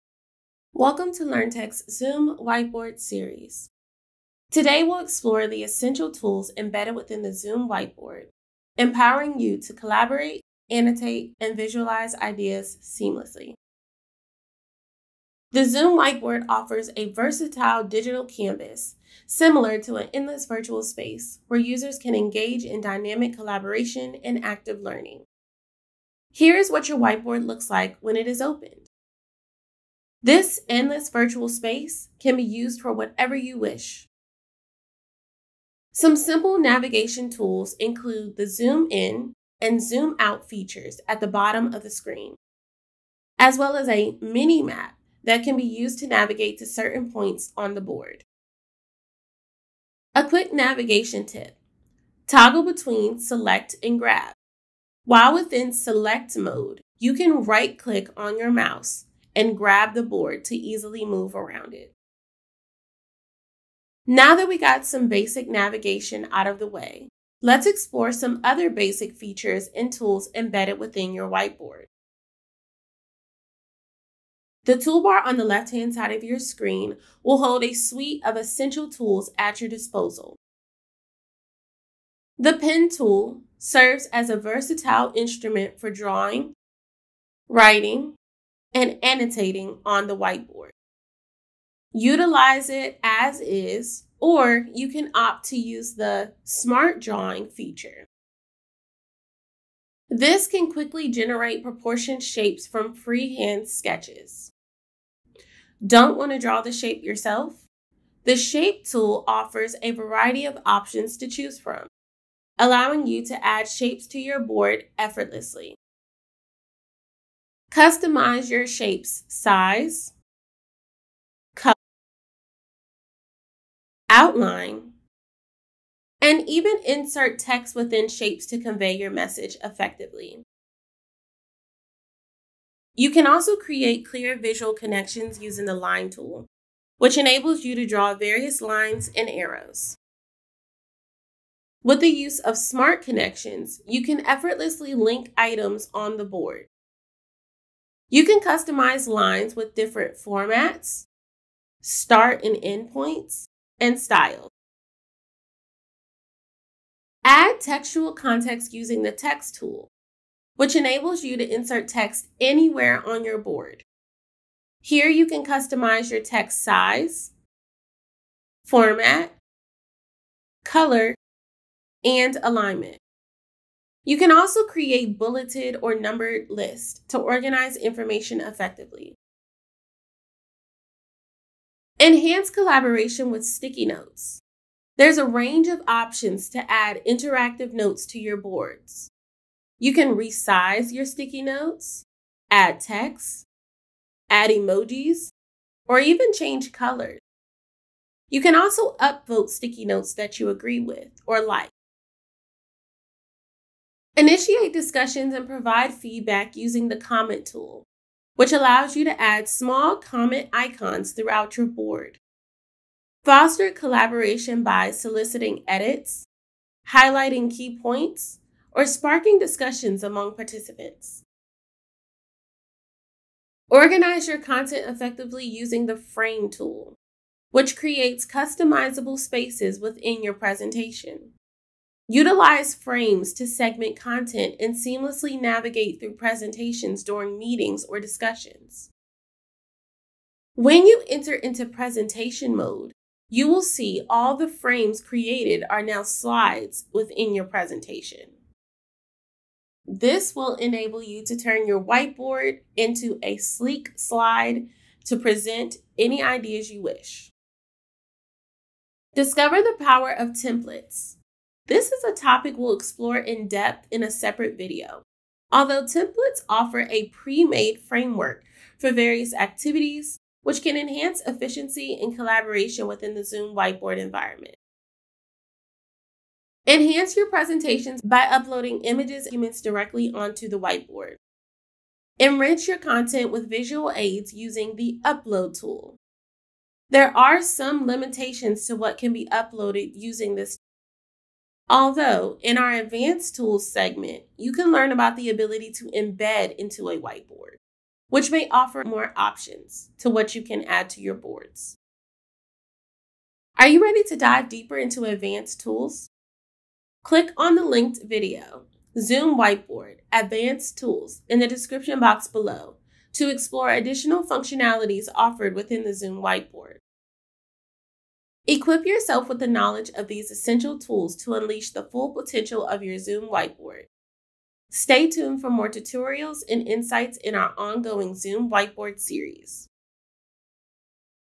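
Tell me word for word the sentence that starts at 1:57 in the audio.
Customize your shape's size, color, outline, and even insert text within shapes to convey your message effectively.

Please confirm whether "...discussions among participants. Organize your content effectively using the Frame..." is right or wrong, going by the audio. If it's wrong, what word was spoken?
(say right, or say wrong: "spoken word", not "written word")
right.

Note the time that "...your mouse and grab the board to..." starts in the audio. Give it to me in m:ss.
0:58.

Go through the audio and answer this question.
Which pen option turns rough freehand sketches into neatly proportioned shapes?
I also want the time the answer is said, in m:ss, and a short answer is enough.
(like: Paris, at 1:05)
Smart Drawing, at 1:36.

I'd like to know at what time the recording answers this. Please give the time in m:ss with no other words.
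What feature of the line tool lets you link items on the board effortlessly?
2:22.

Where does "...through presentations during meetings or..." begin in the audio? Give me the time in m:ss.
3:55.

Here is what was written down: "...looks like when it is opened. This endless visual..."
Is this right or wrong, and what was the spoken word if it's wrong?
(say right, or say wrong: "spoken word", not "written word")
wrong: "virtual", not "visual".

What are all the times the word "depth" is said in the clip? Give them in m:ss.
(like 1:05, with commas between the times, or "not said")
4:23.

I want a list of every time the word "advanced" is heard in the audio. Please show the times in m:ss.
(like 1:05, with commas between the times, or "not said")
4:52, 5:05, 5:10.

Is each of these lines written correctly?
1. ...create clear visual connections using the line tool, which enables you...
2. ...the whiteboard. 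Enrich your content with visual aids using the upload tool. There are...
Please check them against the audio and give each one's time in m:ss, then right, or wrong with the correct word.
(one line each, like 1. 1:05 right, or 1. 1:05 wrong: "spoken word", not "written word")
1. 2:13 right
2. 4:40 right.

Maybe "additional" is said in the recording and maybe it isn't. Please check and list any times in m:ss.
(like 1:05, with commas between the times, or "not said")
5:13.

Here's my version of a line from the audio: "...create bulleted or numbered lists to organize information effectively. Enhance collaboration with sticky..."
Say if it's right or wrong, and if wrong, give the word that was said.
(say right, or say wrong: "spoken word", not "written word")
right.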